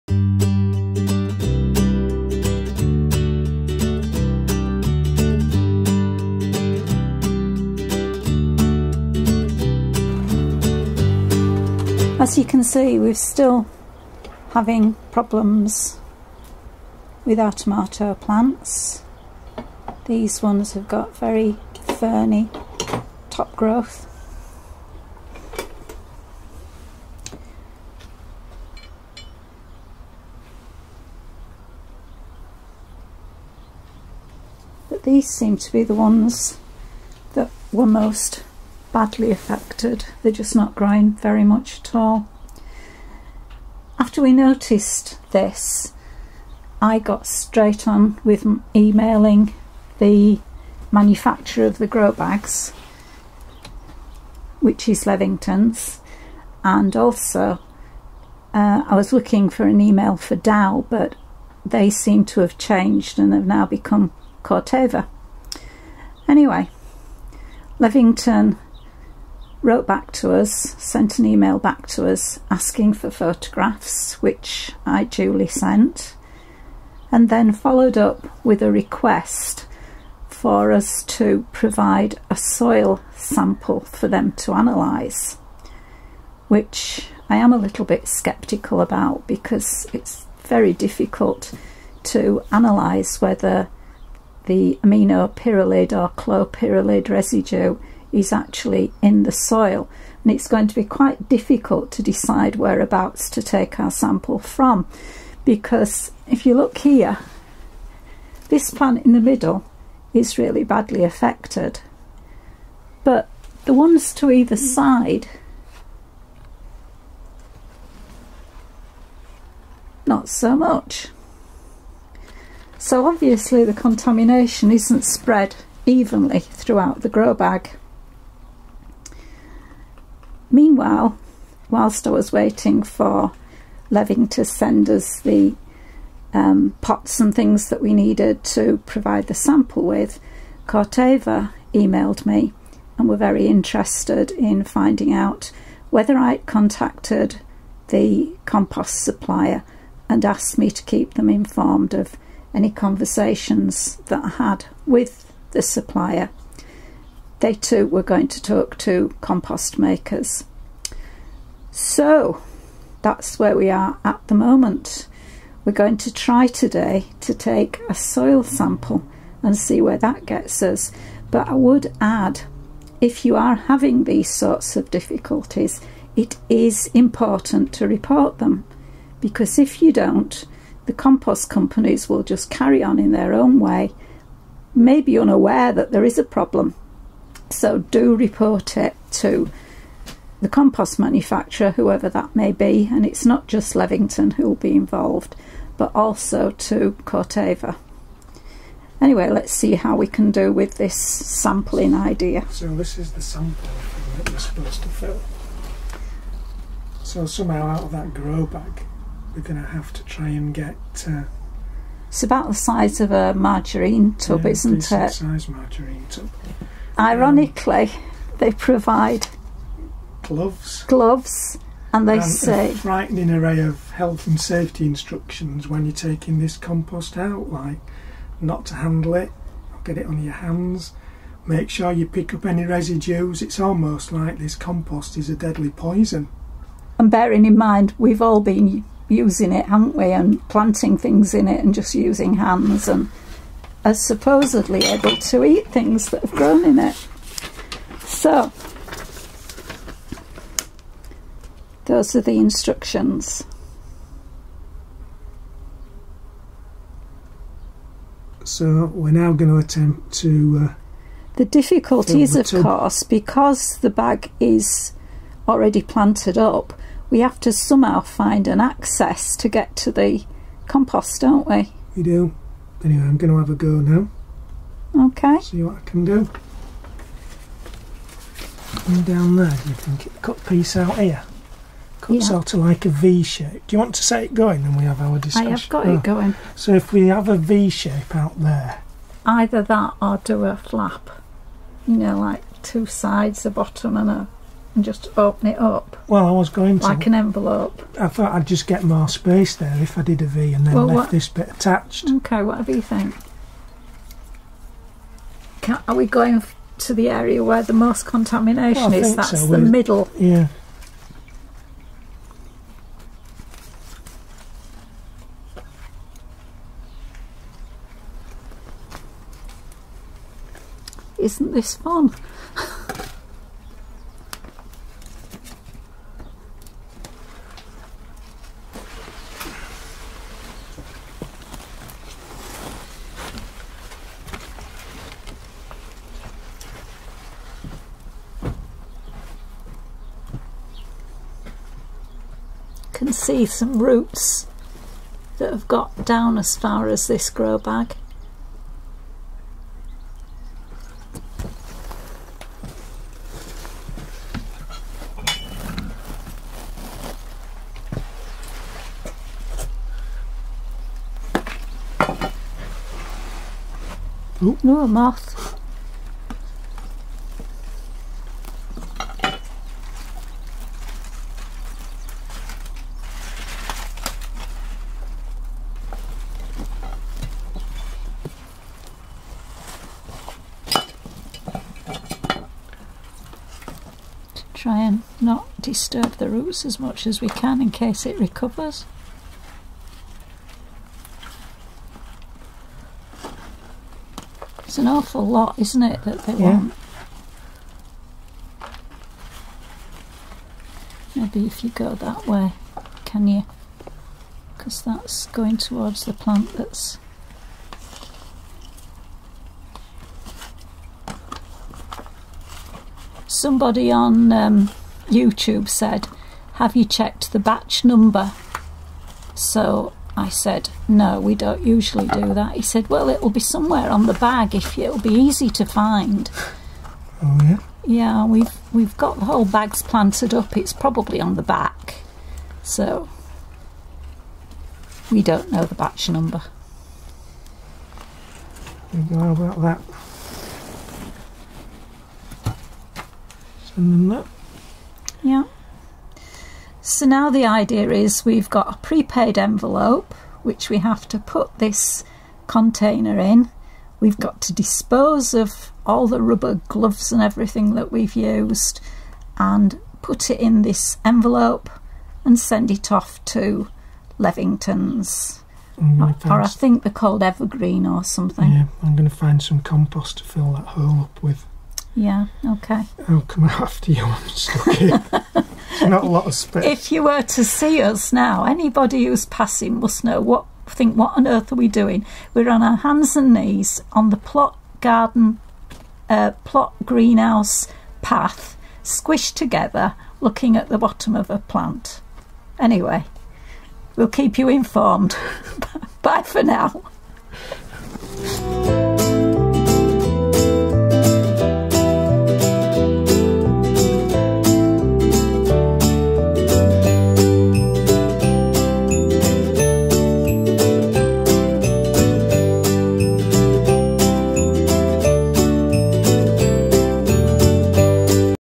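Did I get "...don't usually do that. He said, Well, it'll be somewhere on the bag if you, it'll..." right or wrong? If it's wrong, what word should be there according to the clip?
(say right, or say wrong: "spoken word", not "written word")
right.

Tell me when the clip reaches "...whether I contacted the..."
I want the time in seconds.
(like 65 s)
145 s.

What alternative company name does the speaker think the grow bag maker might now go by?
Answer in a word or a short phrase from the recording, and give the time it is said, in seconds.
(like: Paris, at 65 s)
Evergreen, at 467 s.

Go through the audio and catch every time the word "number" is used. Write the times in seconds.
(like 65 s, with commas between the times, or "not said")
417 s, 436 s.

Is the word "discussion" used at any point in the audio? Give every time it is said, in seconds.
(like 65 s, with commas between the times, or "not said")
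285 s.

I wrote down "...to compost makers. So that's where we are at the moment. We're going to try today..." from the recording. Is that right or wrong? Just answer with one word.
right.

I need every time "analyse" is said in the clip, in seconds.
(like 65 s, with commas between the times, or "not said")
84 s, 92 s.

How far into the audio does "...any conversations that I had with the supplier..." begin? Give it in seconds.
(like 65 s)
152 s.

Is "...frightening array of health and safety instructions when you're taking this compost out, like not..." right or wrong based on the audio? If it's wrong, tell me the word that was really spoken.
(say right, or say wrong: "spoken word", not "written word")
right.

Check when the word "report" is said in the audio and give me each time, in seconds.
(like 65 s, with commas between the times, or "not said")
177 s, 188 s.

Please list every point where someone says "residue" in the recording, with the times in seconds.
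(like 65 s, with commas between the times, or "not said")
97 s, 232 s.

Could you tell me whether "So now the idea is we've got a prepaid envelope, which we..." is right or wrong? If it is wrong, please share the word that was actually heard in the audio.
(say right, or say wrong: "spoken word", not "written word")
right.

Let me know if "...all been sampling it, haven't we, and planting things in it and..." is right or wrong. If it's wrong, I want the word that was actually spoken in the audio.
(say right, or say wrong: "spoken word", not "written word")
wrong: "using", not "sampling".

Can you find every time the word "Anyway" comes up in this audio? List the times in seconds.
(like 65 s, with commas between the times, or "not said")
66 s, 198 s, 272 s, 492 s.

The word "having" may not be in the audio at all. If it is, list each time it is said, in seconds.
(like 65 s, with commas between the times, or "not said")
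14 s, 173 s.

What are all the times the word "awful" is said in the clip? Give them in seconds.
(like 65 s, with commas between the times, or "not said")
394 s.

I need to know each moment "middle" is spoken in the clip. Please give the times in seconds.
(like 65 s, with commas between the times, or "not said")
109 s, 309 s.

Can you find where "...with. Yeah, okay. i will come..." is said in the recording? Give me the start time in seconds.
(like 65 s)
471 s.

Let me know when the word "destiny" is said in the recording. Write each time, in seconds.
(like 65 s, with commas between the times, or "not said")
not said.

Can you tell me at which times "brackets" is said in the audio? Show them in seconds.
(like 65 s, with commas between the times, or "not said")
not said.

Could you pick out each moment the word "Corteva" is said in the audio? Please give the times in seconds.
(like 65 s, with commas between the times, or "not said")
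64 s, 140 s, 197 s.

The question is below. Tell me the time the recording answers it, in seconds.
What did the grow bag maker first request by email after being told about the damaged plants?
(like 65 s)
73 s.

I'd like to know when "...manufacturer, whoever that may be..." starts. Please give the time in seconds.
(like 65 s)
190 s.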